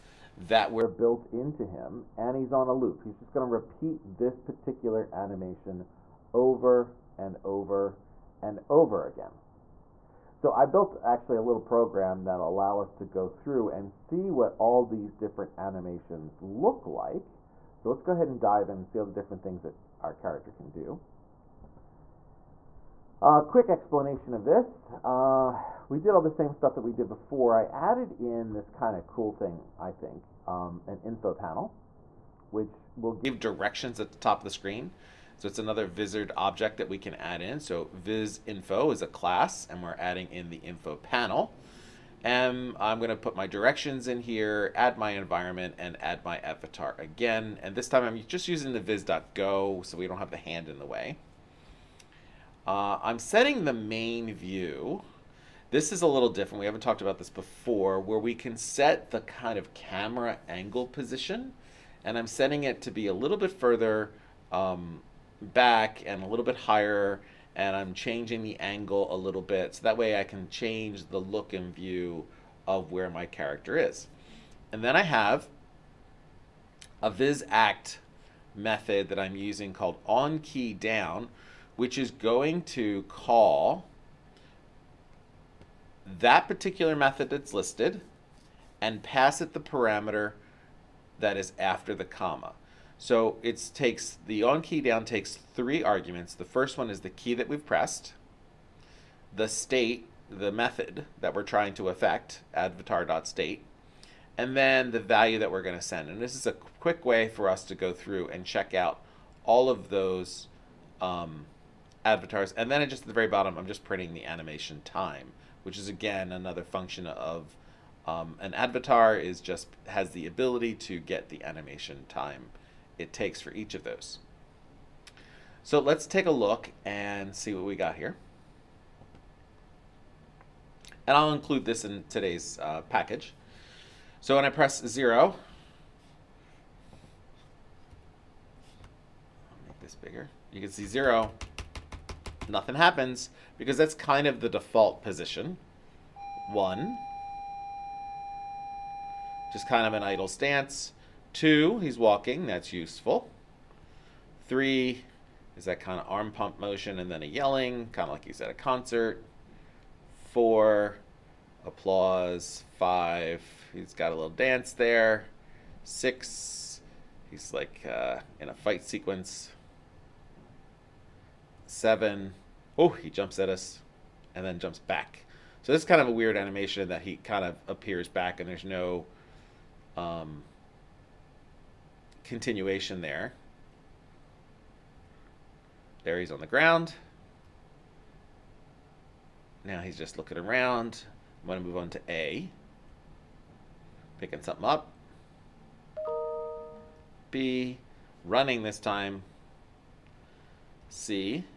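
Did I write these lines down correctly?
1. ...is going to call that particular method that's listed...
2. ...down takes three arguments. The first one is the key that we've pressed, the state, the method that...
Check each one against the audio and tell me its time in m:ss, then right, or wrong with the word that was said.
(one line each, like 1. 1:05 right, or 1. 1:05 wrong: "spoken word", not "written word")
1. 1:21 right
2. 1:34 right.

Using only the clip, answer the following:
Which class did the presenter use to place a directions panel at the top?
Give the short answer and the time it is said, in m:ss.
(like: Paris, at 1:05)
viz info, at 0:37.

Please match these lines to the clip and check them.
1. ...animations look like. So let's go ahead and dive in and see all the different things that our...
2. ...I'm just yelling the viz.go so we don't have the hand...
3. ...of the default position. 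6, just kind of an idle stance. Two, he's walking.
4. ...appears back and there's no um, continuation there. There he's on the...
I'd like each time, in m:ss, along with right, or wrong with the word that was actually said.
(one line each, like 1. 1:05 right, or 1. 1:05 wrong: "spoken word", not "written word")
1. 0:15 right
2. 0:48 wrong: "using", not "yelling"
3. 2:24 wrong: "1", not "6"
4. 2:57 right.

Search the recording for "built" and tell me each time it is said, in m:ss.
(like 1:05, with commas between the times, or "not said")
0:00, 0:10.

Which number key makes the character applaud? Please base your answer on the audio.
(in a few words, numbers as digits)
4.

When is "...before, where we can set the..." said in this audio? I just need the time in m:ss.
0:57.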